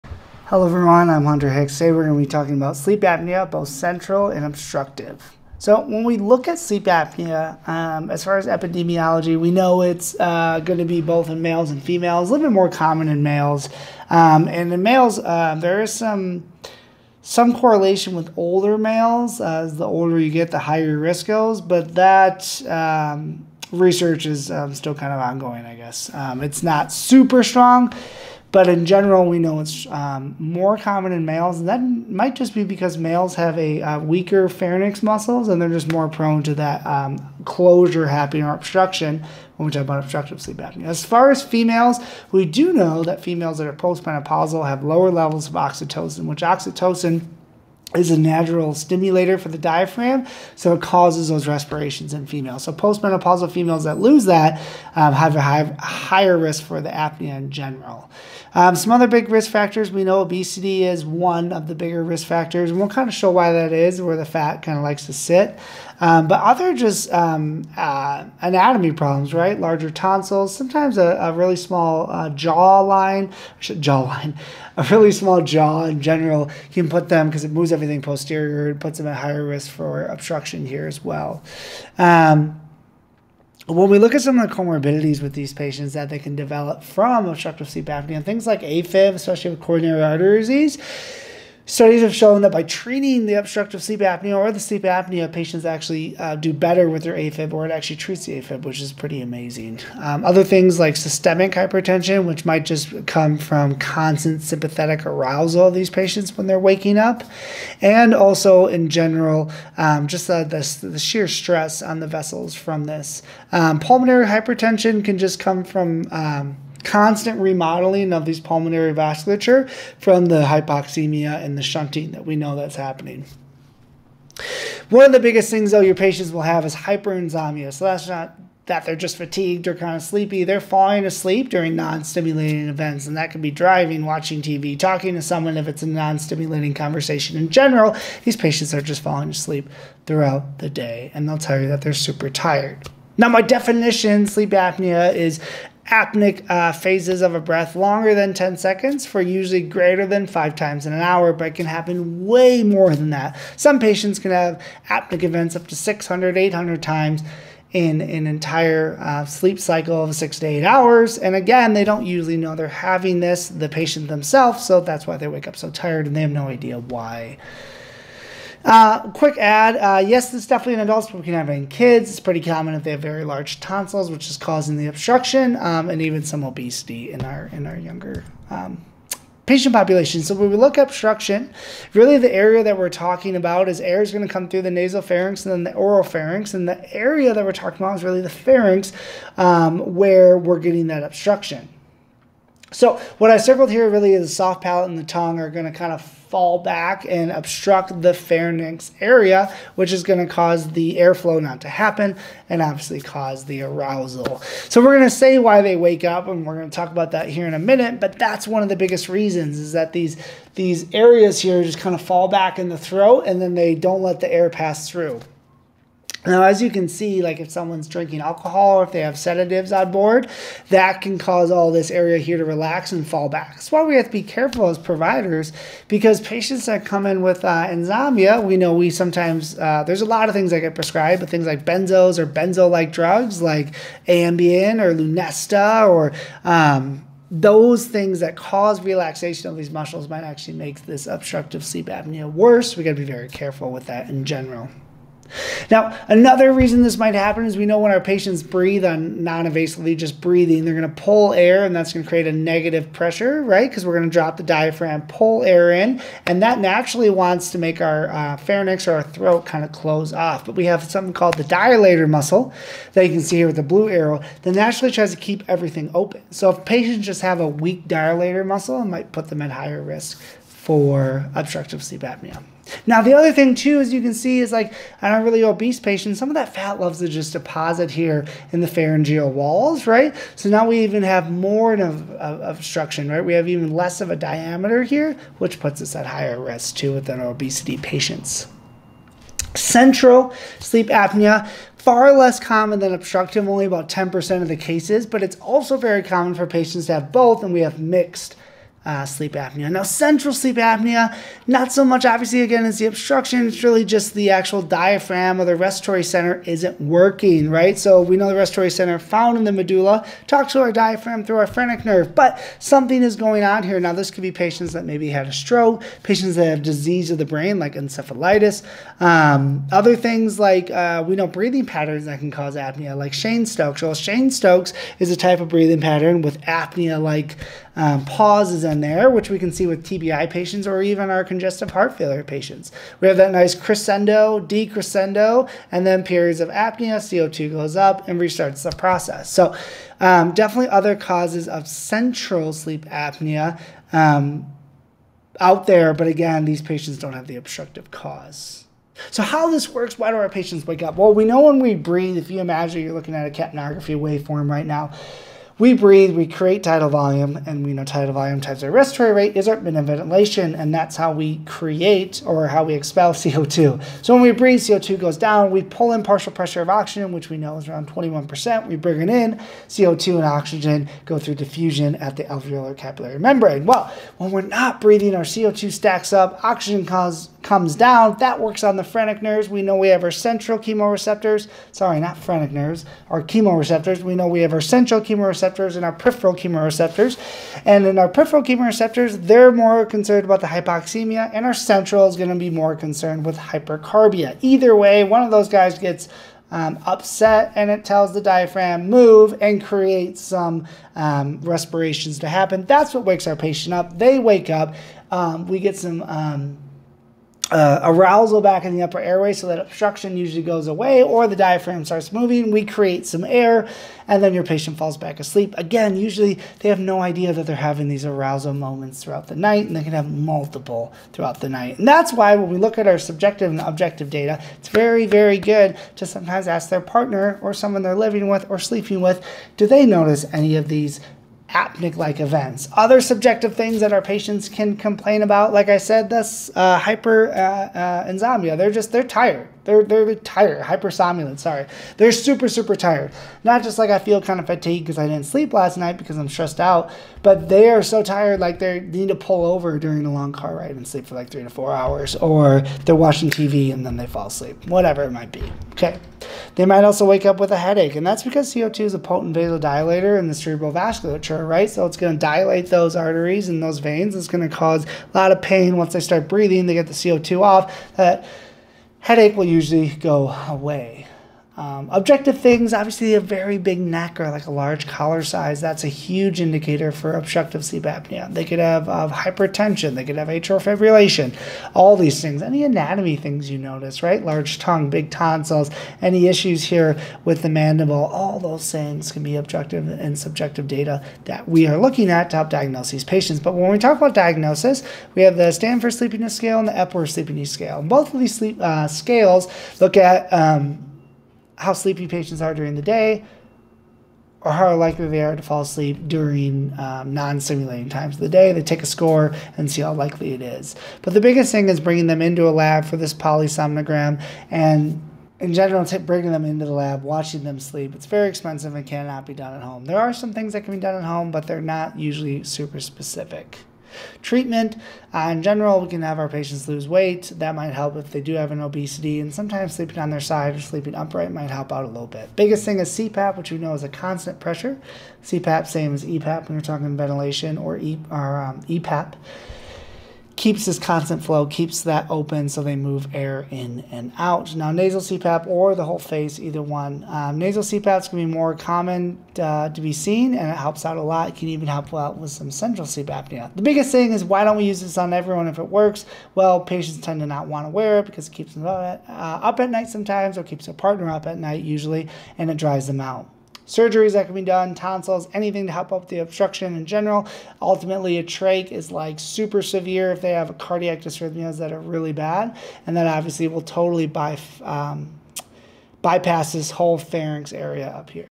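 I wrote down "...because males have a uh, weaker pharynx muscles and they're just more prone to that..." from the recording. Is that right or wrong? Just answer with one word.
right.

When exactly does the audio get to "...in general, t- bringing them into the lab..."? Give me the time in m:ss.
8:35.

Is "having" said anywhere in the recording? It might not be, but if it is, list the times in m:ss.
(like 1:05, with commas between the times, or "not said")
2:42, 6:57.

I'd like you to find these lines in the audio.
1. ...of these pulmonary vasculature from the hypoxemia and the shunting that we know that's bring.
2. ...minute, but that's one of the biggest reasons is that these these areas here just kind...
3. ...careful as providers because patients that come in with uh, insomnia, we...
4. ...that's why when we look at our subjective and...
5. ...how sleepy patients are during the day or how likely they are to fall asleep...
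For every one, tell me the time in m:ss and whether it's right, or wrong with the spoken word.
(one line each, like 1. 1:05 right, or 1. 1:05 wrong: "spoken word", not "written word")
1. 1:58 wrong: "happening", not "bring"
2. 3:27 right
3. 3:44 right
4. 7:01 right
5. 8:21 right.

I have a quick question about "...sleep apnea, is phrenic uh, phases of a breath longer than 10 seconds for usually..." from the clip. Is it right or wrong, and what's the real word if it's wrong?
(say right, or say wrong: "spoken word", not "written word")
wrong: "apneic", not "phrenic".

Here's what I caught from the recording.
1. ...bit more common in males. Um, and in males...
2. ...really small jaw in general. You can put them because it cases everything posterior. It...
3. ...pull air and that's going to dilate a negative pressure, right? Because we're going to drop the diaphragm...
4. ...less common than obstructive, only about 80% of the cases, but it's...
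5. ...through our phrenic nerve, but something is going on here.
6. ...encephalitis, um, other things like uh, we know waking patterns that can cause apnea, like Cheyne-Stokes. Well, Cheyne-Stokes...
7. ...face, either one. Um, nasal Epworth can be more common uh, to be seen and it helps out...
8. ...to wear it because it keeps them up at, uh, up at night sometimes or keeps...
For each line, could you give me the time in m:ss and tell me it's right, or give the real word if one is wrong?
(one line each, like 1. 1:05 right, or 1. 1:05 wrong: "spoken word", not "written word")
1. 0:12 right
2. 1:14 wrong: "moves", not "cases"
3. 4:11 wrong: "create", not "dilate"
4. 4:52 wrong: "10", not "80"
5. 5:11 right
6. 5:17 wrong: "breathing", not "waking"
7. 9:05 wrong: "CPAPs", not "Epworth"
8. 9:17 right.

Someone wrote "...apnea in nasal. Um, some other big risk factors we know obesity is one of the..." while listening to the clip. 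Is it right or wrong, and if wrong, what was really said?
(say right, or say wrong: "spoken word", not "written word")
wrong: "general", not "nasal".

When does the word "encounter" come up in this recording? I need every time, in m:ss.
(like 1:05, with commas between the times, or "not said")
not said.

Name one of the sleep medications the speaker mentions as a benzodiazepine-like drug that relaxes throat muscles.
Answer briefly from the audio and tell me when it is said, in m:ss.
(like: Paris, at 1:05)
Ambien, at 3:54.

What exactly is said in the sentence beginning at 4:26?
So if patients just have a weak dilator muscle, it might put them at higher risk for obstructive sleep apnea.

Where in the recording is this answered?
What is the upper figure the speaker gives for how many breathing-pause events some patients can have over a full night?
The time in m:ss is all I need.
2:36.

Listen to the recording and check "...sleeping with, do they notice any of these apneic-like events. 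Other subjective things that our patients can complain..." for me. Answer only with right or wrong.
right.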